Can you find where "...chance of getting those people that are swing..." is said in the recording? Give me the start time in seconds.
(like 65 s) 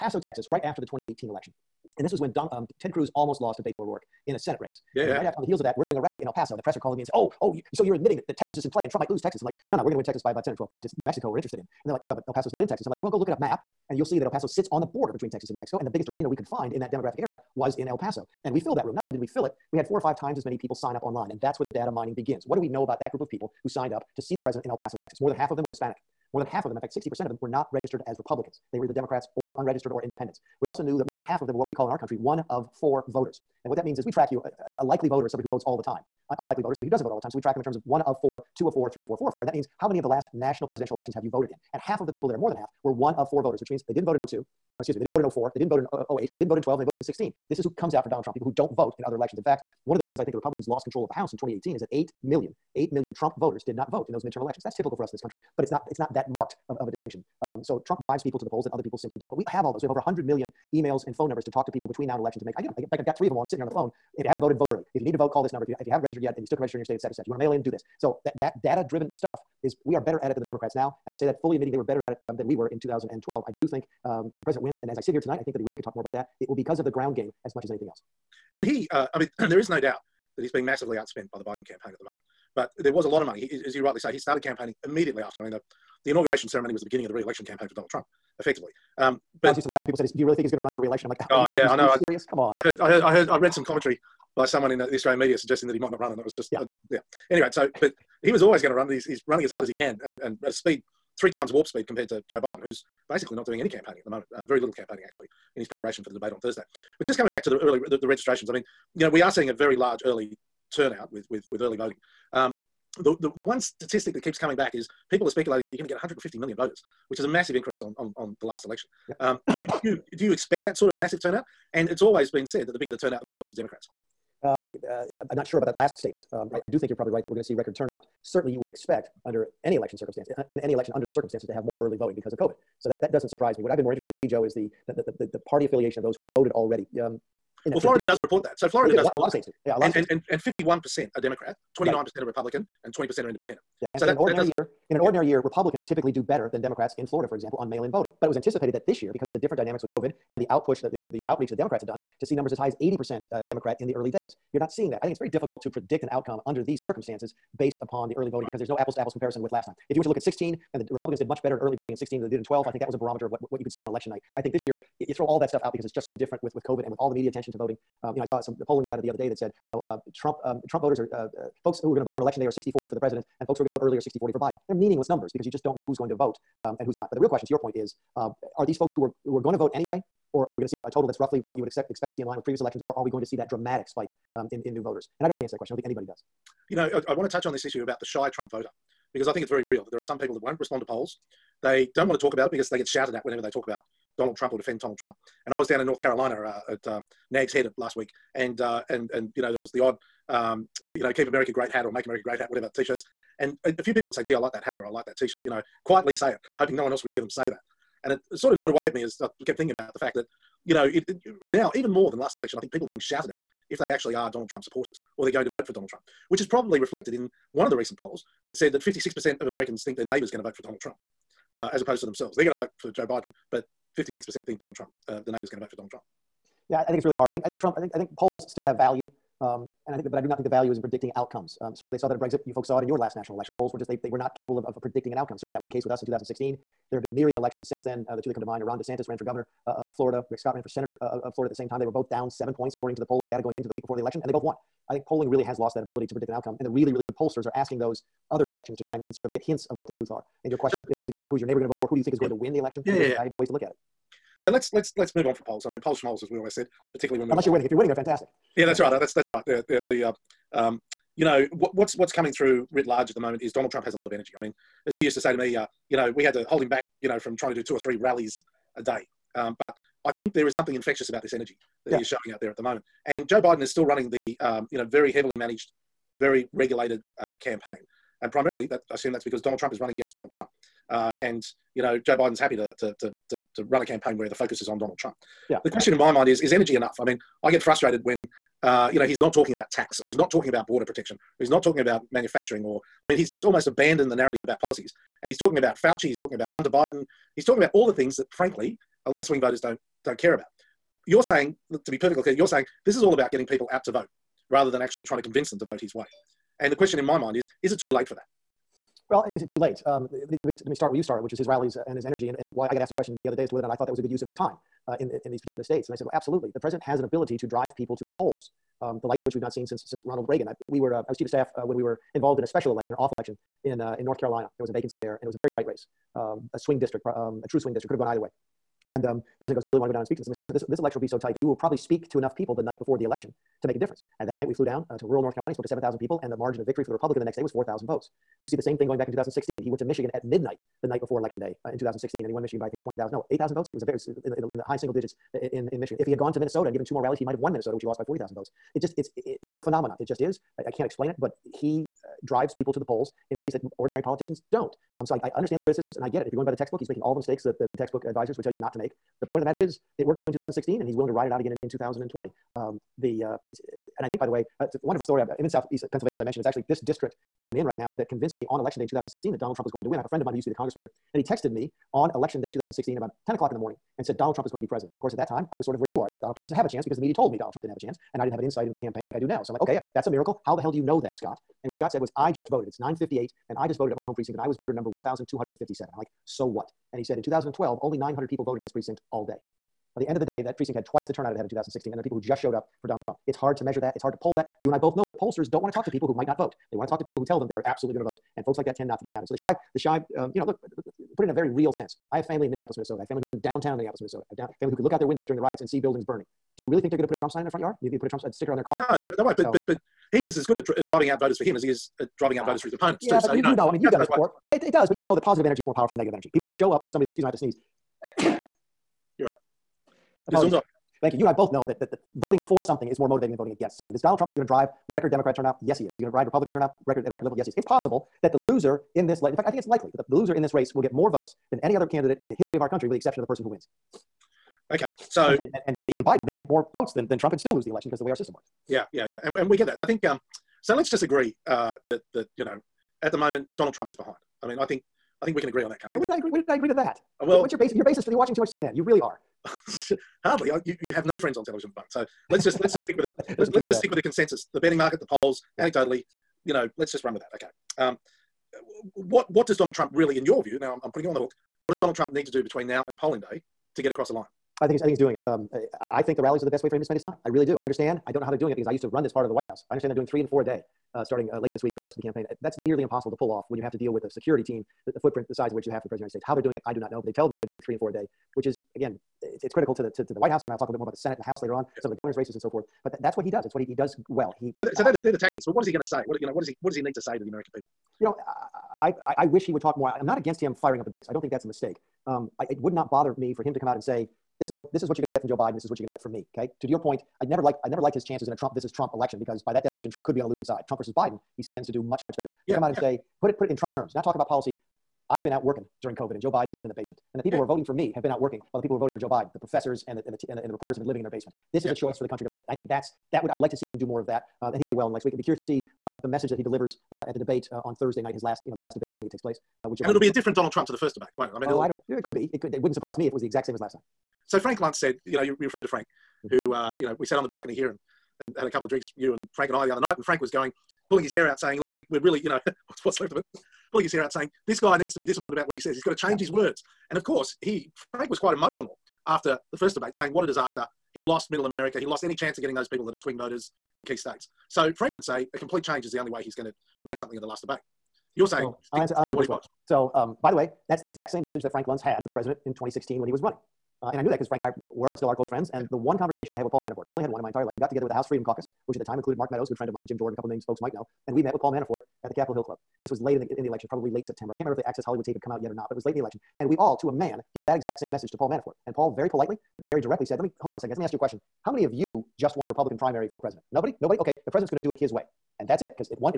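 542 s.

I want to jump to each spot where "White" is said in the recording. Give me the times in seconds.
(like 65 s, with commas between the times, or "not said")
469 s, 480 s.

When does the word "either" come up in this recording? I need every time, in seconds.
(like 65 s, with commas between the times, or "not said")
28 s, 328 s.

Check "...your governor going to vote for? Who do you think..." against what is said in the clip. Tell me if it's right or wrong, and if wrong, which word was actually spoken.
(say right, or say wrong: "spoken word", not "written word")
wrong: "neighbor", not "governor".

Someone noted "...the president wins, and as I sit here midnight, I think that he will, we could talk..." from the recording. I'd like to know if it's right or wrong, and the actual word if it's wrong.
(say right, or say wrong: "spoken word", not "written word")
wrong: "tonight", not "midnight".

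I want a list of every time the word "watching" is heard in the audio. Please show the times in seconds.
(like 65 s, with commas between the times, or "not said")
448 s.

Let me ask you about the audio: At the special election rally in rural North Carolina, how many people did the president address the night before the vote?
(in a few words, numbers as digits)
7,000.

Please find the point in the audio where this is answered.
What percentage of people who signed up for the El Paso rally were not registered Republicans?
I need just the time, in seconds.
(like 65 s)
26 s.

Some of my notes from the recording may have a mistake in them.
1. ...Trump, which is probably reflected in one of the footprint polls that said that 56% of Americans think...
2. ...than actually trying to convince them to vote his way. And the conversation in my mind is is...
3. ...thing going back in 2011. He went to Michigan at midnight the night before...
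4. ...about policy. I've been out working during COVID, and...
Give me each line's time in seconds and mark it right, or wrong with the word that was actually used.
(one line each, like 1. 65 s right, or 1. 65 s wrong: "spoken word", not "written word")
1. 215 s wrong: "recent", not "footprint"
2. 304 s wrong: "question", not "conversation"
3. 338 s wrong: "2016", not "2011"
4. 504 s right.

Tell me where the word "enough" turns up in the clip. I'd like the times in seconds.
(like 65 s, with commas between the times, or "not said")
286 s, 332 s.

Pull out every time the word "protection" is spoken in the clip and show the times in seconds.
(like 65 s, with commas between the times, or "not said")
290 s.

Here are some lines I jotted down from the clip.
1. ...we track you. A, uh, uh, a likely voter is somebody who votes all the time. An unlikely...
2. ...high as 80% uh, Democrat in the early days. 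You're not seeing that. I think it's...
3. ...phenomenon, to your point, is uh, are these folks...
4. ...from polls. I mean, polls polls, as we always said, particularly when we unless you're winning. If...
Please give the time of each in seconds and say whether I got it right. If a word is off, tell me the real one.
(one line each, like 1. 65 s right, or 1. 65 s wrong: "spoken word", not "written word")
1. 34 s right
2. 152 s right
3. 177 s wrong: "question", not "phenomenon"
4. 255 s right.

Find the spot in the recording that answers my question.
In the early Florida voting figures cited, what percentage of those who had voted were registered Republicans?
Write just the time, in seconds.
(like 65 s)
141 s.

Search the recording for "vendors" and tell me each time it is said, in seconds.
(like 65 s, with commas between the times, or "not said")
not said.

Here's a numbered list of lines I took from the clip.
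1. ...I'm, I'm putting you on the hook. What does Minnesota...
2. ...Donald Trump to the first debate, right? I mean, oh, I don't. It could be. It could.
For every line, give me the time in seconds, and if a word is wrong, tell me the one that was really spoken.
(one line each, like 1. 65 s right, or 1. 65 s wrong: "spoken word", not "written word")
1. 460 s wrong: "Donald", not "Minnesota"
2. 520 s right.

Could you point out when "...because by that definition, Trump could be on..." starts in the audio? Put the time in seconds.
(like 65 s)
499 s.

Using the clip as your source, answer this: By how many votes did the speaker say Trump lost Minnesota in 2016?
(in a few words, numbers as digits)
40,000.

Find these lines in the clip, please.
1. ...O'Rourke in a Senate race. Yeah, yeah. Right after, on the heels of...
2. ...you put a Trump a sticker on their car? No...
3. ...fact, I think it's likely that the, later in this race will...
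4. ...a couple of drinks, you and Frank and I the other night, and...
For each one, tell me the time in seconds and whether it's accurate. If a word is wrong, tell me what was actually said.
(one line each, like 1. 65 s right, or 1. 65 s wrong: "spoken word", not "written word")
1. 3 s right
2. 407 s right
3. 429 s wrong: "loser", not "later"
4. 528 s right.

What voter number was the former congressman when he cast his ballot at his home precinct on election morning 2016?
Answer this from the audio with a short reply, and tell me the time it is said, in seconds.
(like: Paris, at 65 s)
1,257, at 384 s.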